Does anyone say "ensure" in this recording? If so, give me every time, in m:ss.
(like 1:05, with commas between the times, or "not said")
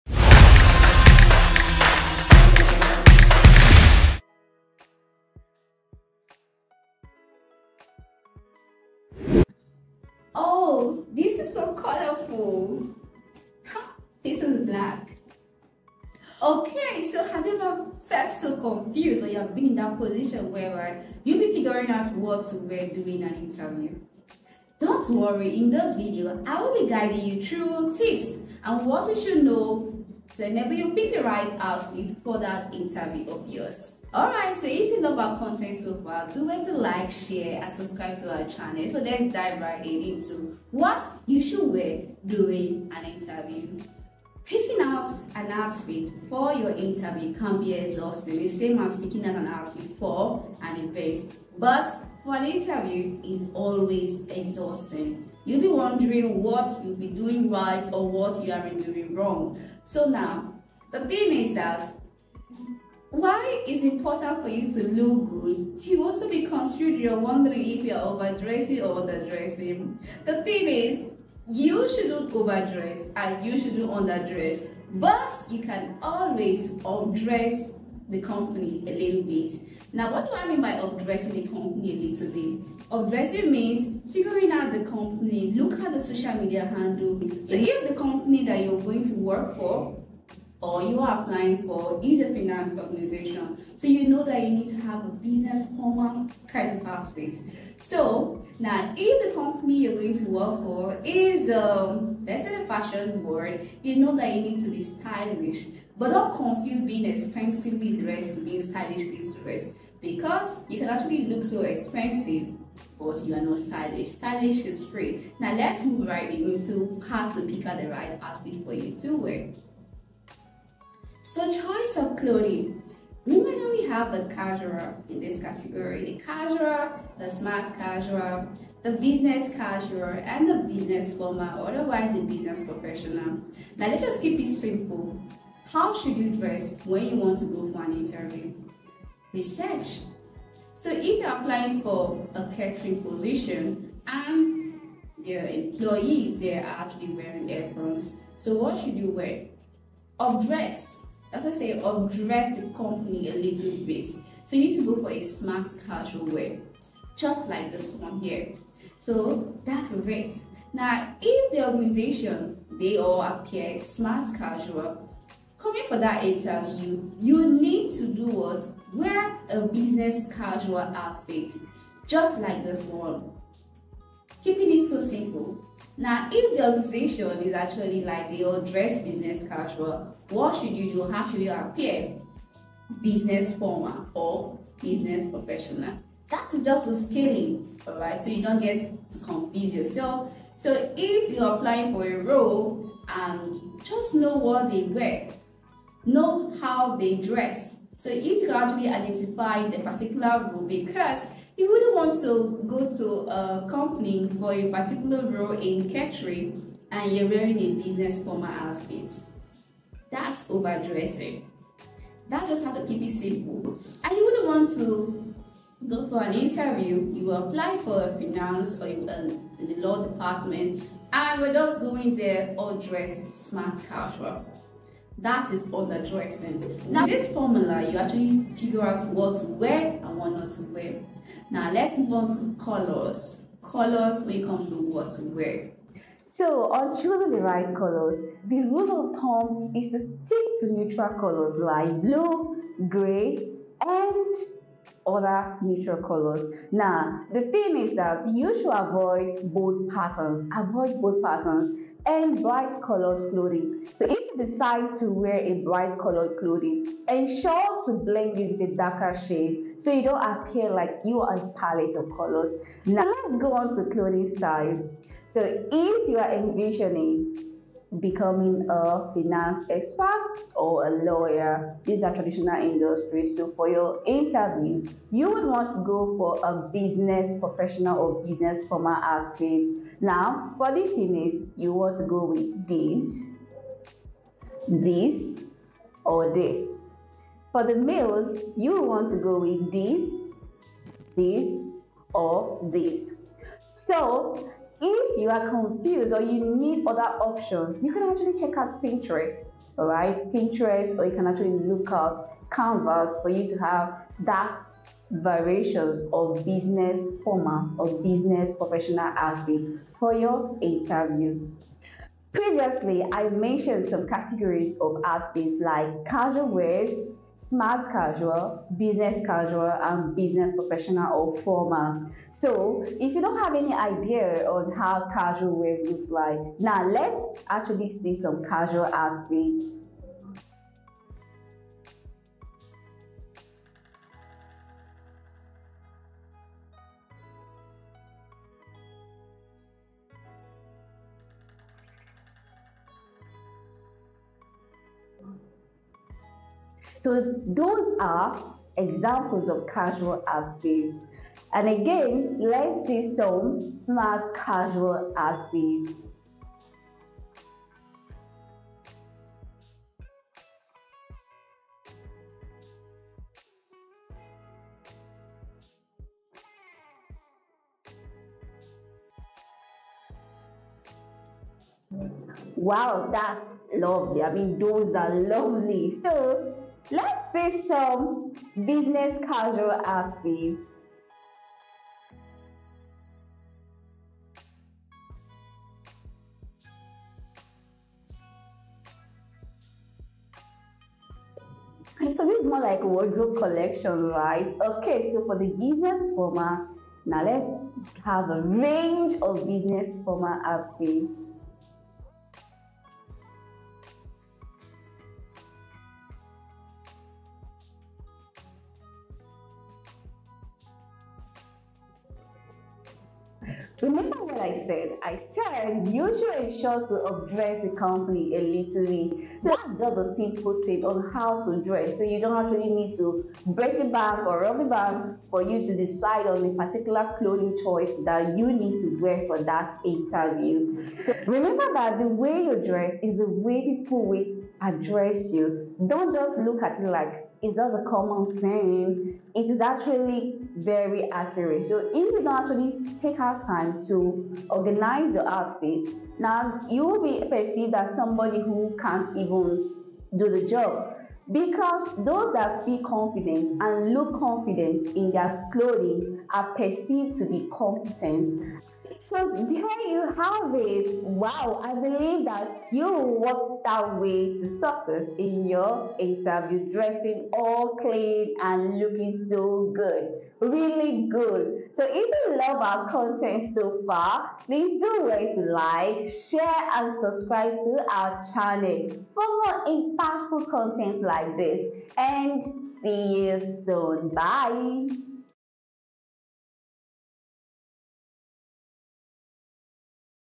4:17, 6:56.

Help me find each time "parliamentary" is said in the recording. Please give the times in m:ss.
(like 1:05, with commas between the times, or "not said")
not said.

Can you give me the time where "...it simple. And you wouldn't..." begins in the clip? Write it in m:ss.
3:33.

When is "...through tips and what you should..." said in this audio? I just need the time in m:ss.
0:27.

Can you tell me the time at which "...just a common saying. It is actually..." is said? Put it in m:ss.
7:17.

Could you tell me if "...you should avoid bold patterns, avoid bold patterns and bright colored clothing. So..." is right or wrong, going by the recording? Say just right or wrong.
right.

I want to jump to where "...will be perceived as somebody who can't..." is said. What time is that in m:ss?
7:26.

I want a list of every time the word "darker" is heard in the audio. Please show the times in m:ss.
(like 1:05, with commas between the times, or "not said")
4:18.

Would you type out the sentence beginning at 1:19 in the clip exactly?
Now, what do I mean by addressing the company a little bit?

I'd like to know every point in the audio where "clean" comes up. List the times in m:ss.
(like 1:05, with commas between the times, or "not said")
7:47.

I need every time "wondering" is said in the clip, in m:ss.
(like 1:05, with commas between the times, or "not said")
0:55, 1:07.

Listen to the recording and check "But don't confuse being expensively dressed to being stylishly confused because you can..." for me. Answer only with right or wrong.
wrong.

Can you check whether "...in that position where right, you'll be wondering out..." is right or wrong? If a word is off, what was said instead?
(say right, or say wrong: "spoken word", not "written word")
wrong: "figuring", not "wondering".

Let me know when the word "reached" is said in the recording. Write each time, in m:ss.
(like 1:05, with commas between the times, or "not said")
not said.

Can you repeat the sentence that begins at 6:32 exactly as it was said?
So this is more like wardrobe collection, right?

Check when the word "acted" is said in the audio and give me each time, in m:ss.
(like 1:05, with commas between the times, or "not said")
not said.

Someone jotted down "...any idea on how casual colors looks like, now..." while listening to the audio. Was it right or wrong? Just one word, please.
wrong.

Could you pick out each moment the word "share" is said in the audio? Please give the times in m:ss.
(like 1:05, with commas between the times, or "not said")
0:37, 7:56.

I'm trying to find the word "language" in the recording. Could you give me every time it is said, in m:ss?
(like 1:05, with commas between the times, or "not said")
not said.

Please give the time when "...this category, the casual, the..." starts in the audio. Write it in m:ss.
2:05.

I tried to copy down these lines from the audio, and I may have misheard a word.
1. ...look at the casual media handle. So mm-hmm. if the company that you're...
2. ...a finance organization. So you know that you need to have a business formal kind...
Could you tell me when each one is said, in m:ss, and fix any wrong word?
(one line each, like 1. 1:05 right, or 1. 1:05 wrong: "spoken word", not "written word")
1. 1:25 wrong: "social", not "casual"
2. 1:32 right.